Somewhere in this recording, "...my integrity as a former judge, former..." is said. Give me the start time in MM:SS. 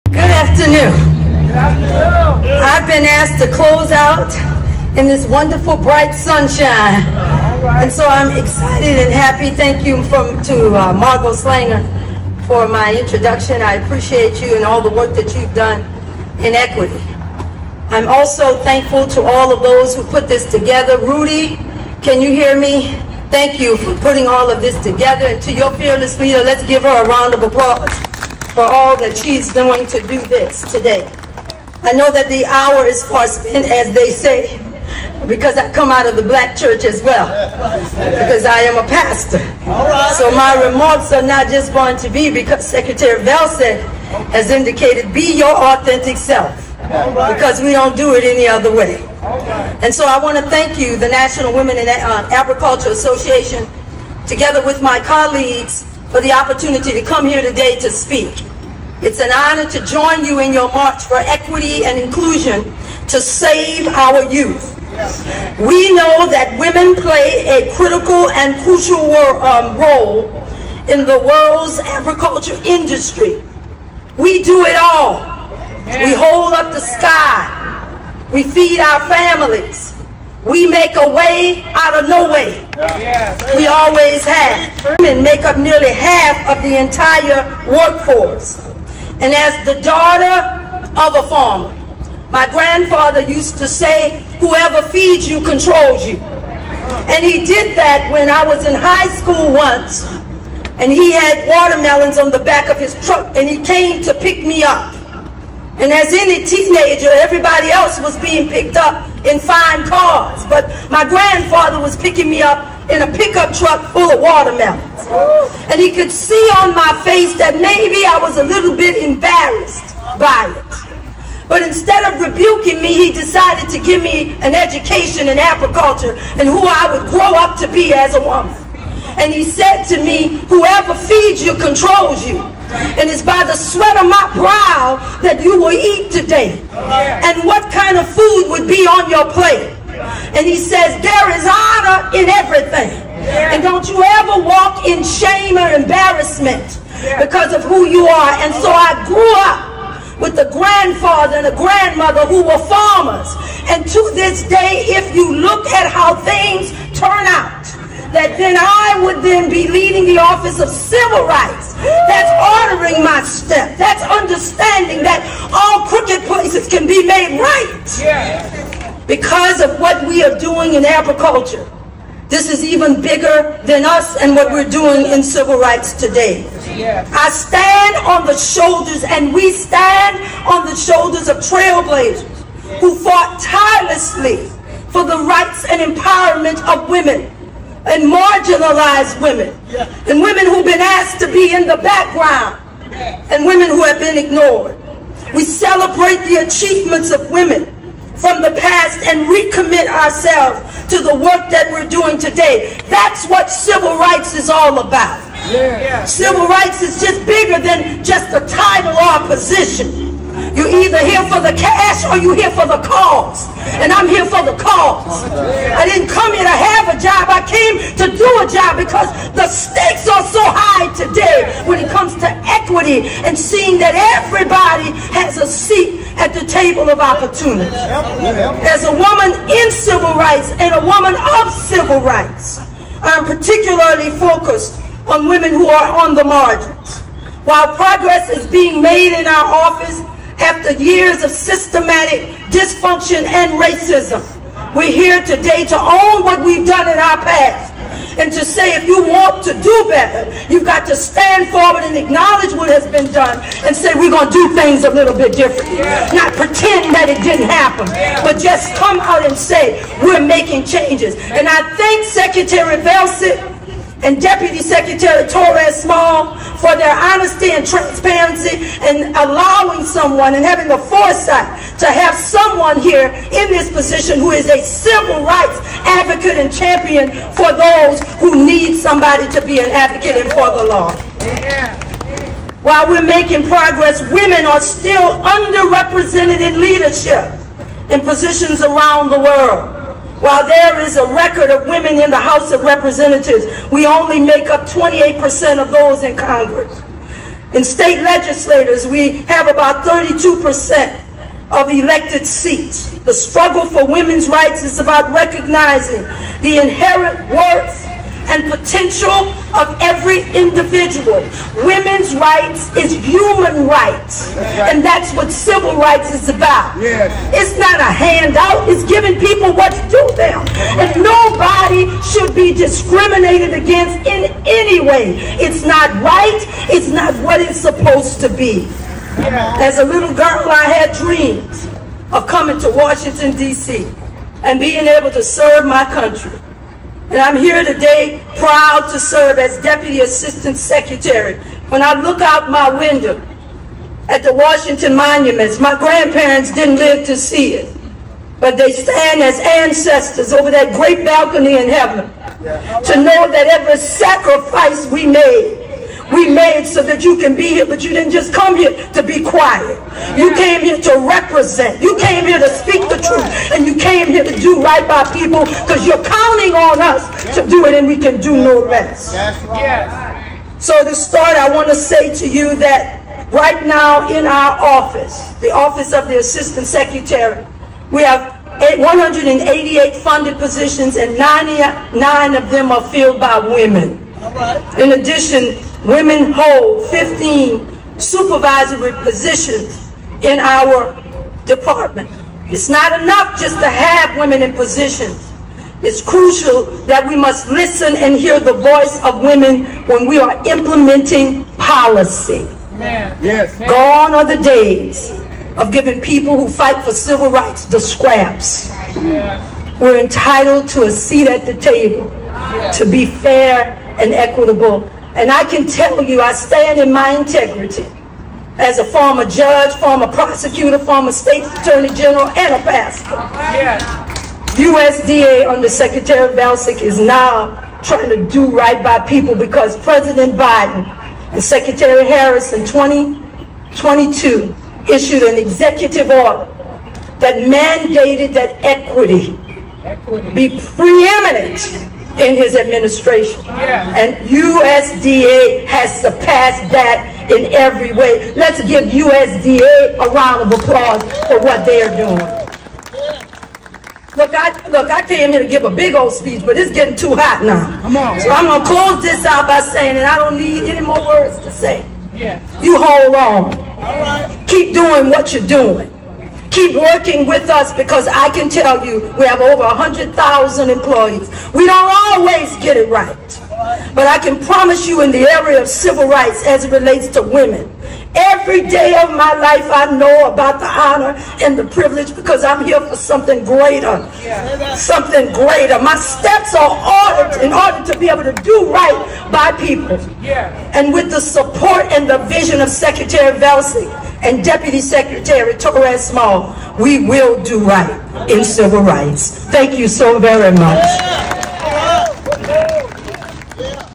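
06:56.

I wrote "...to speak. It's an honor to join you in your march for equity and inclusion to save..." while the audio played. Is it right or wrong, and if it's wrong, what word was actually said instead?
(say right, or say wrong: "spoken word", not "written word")
right.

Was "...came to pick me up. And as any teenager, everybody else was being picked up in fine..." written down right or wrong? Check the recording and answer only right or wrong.
right.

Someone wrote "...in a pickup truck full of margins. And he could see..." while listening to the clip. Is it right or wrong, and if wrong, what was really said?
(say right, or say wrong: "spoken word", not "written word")
wrong: "watermelons", not "margins".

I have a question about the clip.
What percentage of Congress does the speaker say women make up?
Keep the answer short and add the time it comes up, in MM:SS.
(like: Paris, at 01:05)
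28%, at 04:54.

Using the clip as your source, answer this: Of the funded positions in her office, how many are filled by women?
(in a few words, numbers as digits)
99.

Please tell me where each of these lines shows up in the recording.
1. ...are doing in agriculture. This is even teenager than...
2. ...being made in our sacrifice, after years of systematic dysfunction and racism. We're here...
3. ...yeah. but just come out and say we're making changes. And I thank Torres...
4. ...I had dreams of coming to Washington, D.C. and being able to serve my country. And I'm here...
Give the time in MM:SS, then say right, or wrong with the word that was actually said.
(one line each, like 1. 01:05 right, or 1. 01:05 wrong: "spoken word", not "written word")
1. 02:50 wrong: "bigger", not "teenager"
2. 03:58 wrong: "office", not "sacrifice"
3. 04:17 wrong: "Secretary", not "Torres"
4. 05:30 right.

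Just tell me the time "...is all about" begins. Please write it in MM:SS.
03:24.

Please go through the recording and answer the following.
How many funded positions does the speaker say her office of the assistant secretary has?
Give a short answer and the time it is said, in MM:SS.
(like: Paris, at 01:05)
188, at 06:18.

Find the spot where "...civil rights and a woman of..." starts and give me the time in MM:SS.
03:49.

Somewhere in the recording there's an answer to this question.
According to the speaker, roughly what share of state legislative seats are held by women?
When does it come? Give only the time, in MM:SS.
04:59.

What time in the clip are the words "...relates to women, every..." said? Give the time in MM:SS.
07:56.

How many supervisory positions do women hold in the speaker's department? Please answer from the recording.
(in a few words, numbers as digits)
15.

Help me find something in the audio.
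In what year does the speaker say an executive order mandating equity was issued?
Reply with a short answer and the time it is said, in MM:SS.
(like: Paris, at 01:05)
2022, at 07:12.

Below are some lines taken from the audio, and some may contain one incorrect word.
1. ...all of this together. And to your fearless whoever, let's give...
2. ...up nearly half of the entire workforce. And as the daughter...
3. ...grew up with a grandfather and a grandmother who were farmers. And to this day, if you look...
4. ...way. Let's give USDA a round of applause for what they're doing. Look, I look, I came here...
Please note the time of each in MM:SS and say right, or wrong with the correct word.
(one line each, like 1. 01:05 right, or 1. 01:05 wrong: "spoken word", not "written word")
1. 00:24 wrong: "leader", not "whoever"
2. 01:25 right
3. 02:29 right
4. 07:27 right.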